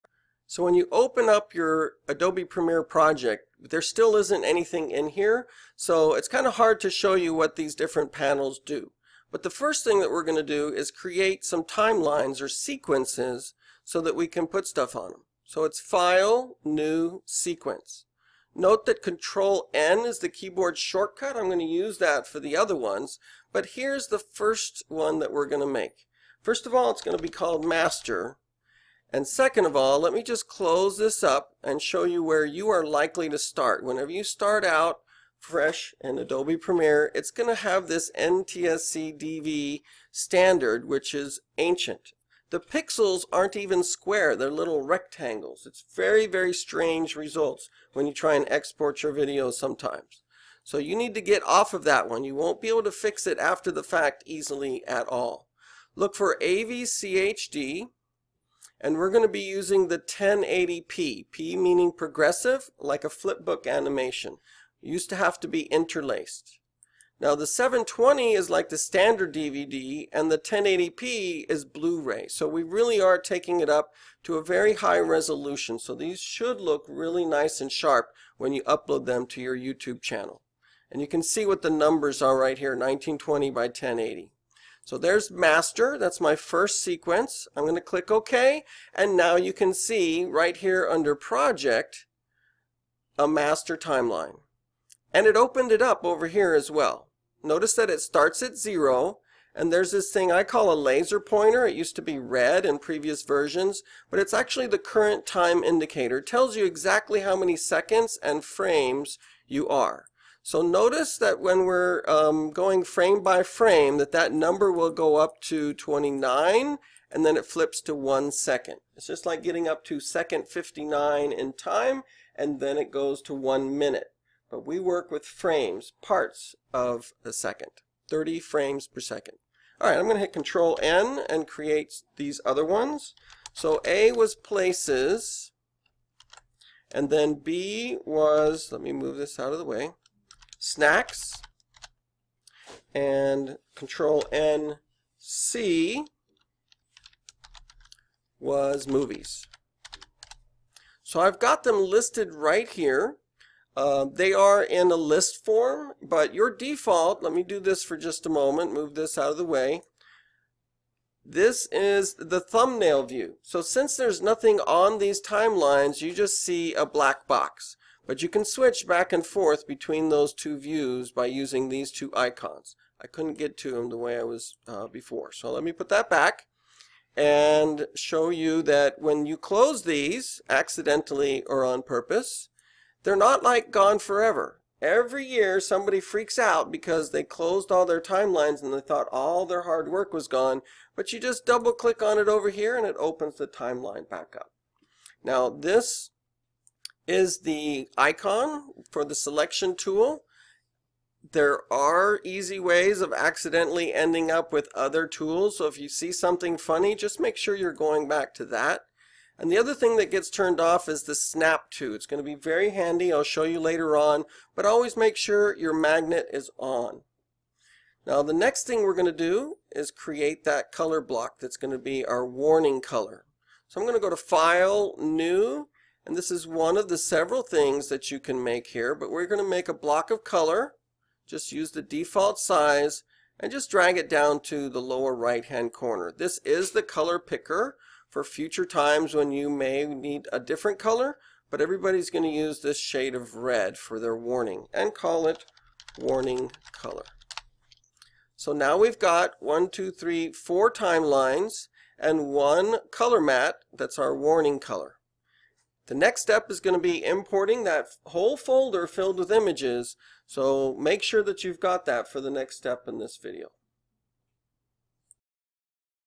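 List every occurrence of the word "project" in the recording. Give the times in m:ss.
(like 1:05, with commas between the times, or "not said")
0:02, 1:31.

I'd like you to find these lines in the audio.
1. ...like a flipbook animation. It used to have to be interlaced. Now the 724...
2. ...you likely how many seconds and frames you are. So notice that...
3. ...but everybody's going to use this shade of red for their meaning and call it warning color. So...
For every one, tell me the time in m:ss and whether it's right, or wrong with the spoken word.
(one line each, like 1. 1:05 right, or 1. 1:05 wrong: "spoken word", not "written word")
1. 1:02 wrong: "720", not "724"
2. 1:46 wrong: "exactly", not "likely"
3. 4:01 wrong: "warning", not "meaning".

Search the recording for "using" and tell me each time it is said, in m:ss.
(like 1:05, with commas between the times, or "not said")
0:59, 2:51.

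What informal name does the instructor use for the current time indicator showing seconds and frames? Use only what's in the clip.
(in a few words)
laser pointer.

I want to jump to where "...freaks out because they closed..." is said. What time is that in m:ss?
3:05.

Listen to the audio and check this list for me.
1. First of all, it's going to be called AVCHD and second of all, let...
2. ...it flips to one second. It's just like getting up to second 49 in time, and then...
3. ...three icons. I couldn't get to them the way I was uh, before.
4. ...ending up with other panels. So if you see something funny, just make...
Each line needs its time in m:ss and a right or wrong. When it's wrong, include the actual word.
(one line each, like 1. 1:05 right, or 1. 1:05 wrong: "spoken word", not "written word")
1. 0:26 wrong: "Master", not "AVCHD"
2. 1:57 wrong: "59", not "49"
3. 2:51 wrong: "two", not "three"
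4. 3:23 wrong: "tools", not "panels".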